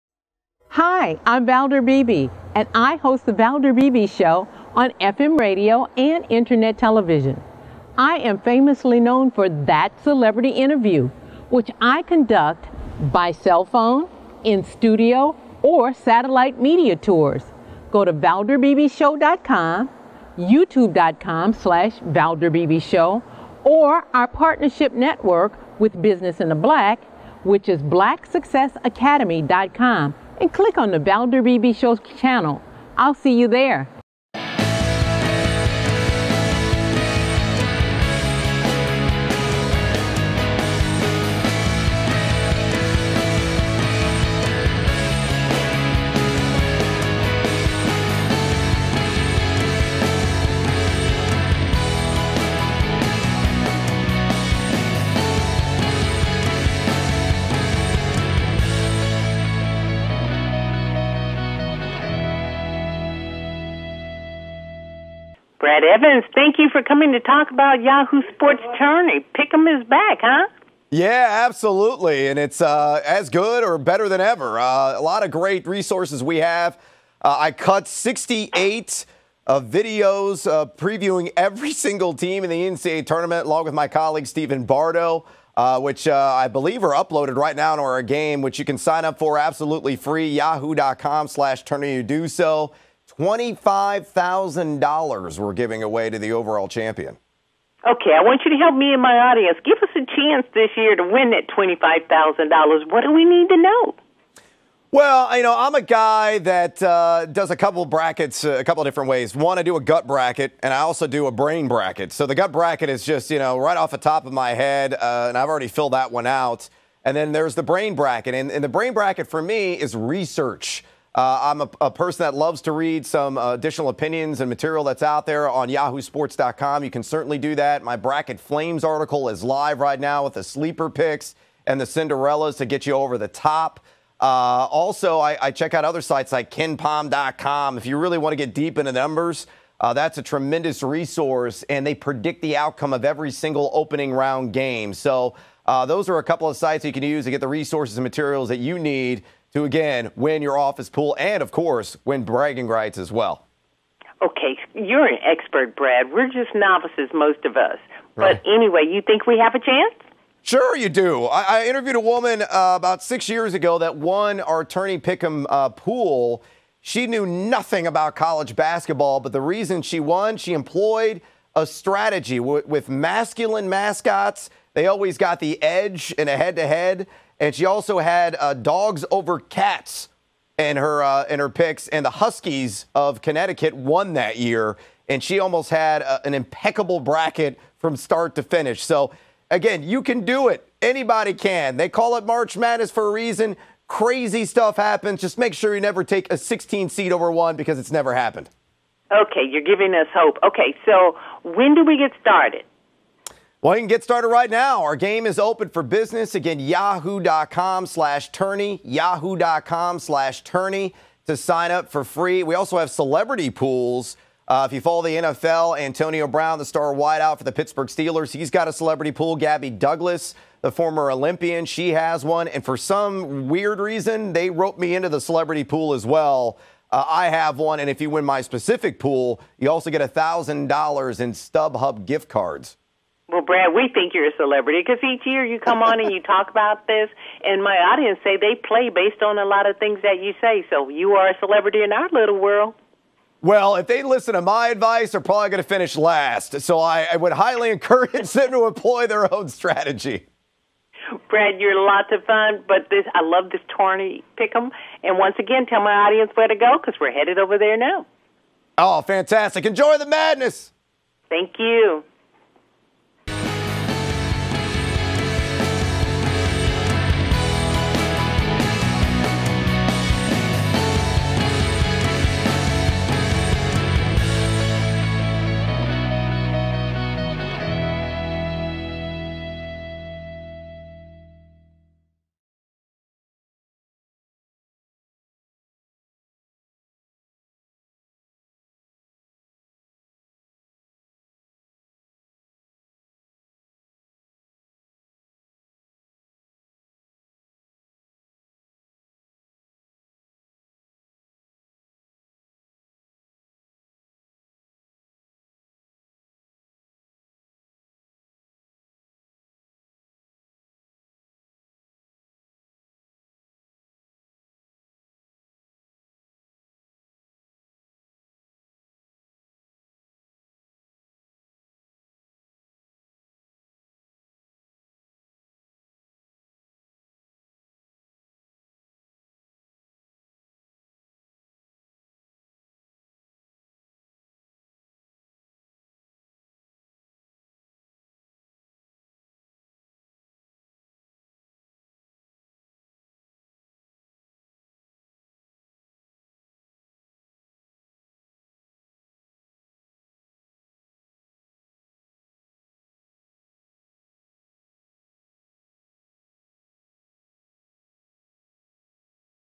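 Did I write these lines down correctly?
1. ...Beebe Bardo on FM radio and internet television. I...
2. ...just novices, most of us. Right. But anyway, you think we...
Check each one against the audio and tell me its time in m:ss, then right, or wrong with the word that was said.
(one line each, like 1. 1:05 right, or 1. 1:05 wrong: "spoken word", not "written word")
1. 0:03 wrong: "Show", not "Bardo"
2. 2:36 right.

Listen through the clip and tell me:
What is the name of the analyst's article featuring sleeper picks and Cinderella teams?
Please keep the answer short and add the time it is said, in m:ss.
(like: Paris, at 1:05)
Bracket Flames, at 2:07.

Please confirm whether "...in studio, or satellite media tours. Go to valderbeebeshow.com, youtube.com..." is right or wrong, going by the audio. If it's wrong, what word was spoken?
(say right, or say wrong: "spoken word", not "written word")
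right.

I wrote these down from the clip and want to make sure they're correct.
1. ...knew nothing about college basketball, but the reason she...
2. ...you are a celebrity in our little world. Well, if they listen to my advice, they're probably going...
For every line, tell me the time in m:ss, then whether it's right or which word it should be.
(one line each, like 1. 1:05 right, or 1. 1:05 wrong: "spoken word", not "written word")
1. 2:47 right
2. 4:00 right.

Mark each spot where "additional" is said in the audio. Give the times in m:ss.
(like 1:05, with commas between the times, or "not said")
2:03.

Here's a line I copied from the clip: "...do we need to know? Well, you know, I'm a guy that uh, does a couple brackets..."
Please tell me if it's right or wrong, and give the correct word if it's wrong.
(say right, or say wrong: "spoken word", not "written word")
right.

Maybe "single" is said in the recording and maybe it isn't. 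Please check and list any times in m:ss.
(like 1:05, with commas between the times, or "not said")
1:21, 2:23.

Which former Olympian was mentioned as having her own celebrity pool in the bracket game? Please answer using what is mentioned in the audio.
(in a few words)
Gabby Douglas.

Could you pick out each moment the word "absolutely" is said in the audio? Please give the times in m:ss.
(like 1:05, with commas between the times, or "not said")
1:11, 1:29.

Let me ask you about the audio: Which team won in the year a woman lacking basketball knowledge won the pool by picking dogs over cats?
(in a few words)
Huskies of Connecticut.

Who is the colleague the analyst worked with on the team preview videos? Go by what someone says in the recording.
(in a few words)
Stephen Bardo.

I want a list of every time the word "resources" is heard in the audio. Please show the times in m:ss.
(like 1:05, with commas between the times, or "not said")
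1:15, 2:20, 2:27.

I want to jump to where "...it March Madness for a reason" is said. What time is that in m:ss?
3:12.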